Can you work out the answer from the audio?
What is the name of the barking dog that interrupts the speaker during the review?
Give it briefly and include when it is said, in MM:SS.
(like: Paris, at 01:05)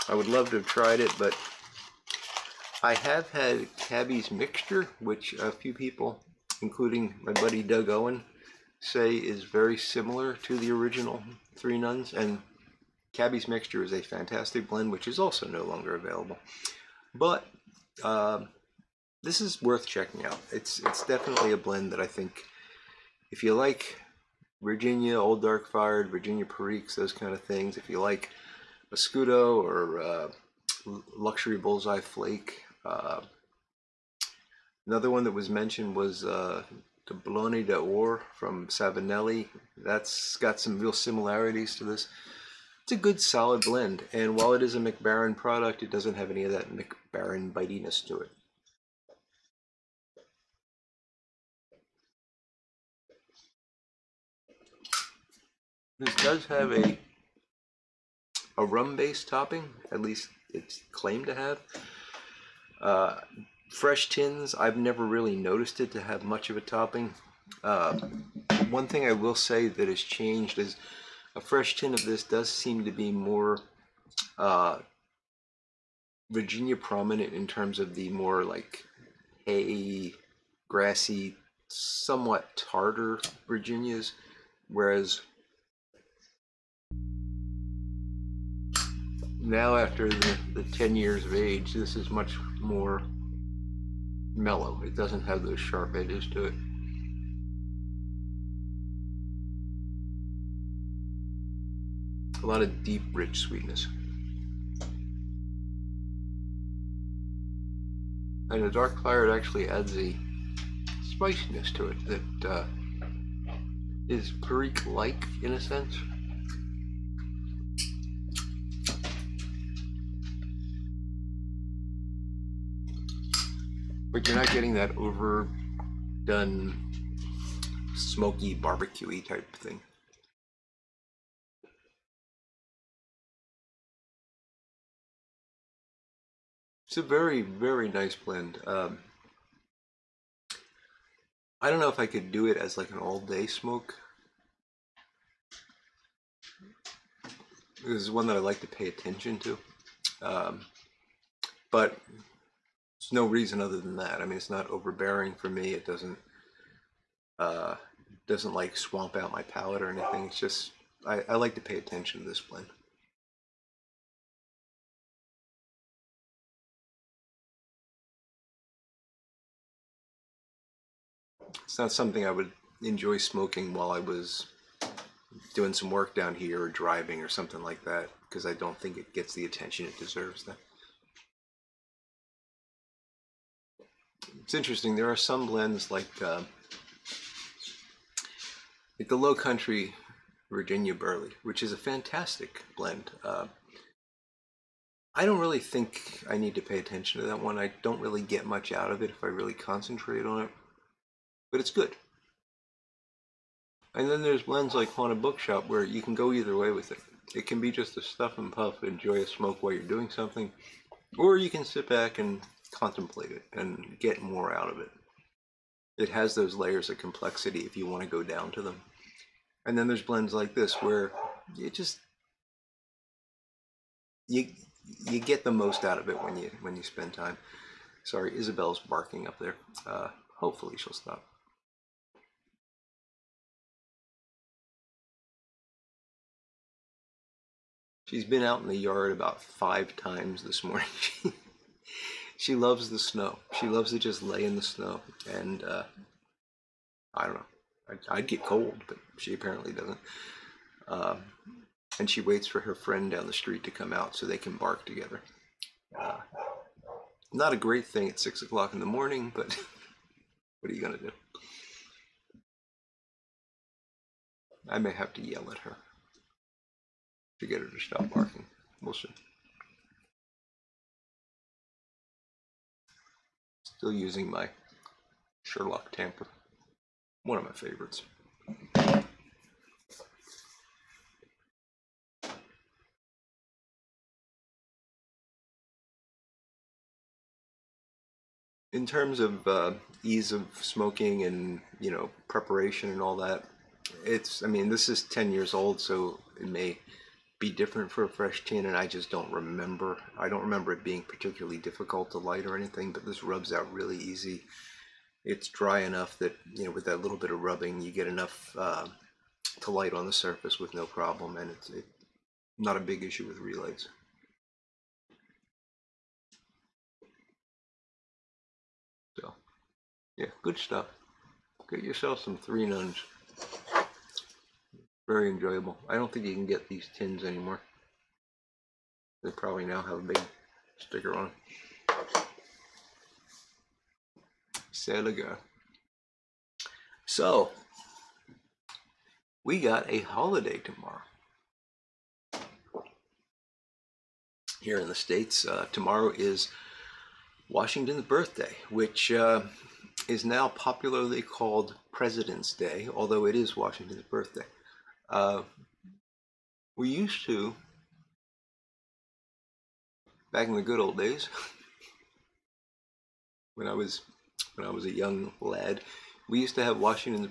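Isabel, at 03:48.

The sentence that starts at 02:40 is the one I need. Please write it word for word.
It's just, I, I like to pay attention to this blend.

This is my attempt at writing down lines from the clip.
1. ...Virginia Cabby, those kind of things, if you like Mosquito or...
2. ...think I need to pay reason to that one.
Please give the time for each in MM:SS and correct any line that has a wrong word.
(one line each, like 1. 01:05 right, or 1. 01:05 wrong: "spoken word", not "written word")
1. 00:26 wrong: "Periques", not "Cabby"
2. 03:15 wrong: "attention", not "reason".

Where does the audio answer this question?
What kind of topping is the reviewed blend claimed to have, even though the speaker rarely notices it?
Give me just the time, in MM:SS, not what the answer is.
00:58.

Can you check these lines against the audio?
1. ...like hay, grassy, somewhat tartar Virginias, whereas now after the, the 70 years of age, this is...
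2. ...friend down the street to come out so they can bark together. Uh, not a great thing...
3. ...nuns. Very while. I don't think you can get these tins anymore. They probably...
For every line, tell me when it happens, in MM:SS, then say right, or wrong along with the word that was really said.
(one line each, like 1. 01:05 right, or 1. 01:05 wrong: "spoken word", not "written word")
1. 01:18 wrong: "10", not "70"
2. 04:12 right
3. 05:22 wrong: "enjoyable", not "while".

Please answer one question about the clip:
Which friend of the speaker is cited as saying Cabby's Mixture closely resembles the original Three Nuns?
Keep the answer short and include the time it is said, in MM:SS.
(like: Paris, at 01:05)
Doug Owen, at 00:07.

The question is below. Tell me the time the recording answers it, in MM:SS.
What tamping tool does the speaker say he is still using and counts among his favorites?
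04:35.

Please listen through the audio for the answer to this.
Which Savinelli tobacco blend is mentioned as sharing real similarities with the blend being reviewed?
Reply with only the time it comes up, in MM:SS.
00:37.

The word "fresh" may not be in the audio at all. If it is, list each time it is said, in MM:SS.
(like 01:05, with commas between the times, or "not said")
01:03, 01:11, 04:58.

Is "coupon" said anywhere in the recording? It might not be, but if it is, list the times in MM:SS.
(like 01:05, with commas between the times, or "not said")
not said.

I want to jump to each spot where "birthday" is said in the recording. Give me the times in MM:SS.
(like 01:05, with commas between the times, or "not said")
05:48, 05:54.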